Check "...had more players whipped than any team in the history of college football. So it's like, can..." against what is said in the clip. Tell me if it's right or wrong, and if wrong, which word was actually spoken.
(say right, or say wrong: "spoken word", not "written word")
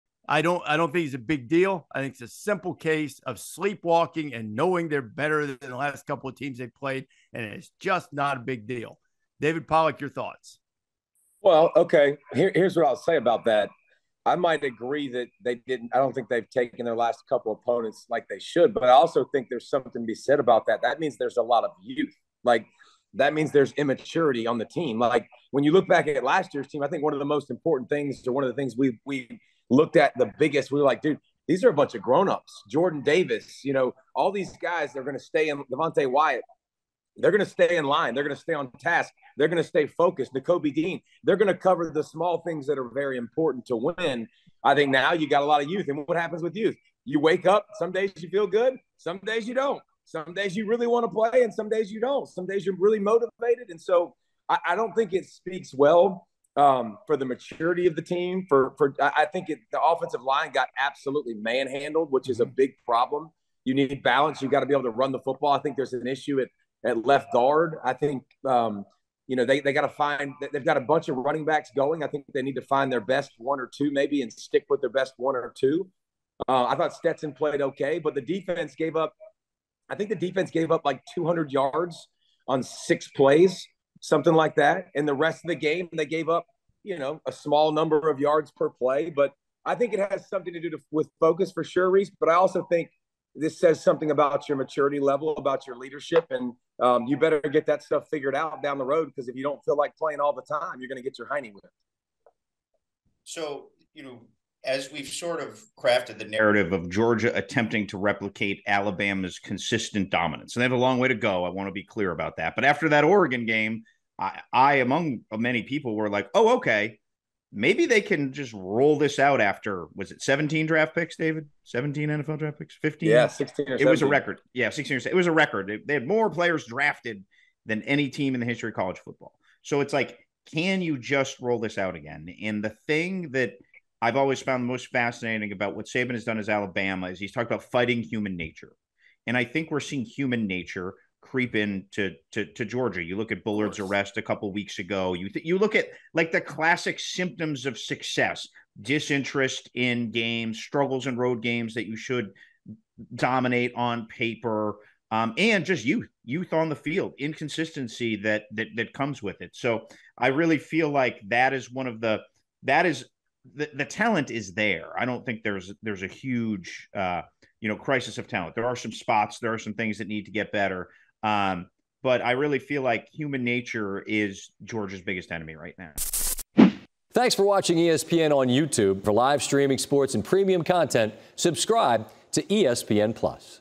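wrong: "drafted", not "whipped".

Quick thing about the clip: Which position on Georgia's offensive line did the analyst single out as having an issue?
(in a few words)
Left guard.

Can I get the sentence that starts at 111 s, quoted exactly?
I want to be clear about that.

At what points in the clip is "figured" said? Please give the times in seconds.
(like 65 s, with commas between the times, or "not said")
98 s.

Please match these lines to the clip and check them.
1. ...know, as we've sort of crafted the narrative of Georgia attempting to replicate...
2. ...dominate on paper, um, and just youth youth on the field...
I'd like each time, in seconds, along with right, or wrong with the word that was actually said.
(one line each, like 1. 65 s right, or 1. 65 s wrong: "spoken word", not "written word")
1. 104 s right
2. 153 s right.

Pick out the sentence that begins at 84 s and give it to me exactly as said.
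And the rest of the game, they gave up, you know, a small number of yards per play.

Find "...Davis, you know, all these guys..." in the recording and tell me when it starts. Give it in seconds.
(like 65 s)
33 s.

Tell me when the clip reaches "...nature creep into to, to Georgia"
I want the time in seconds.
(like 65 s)
140 s.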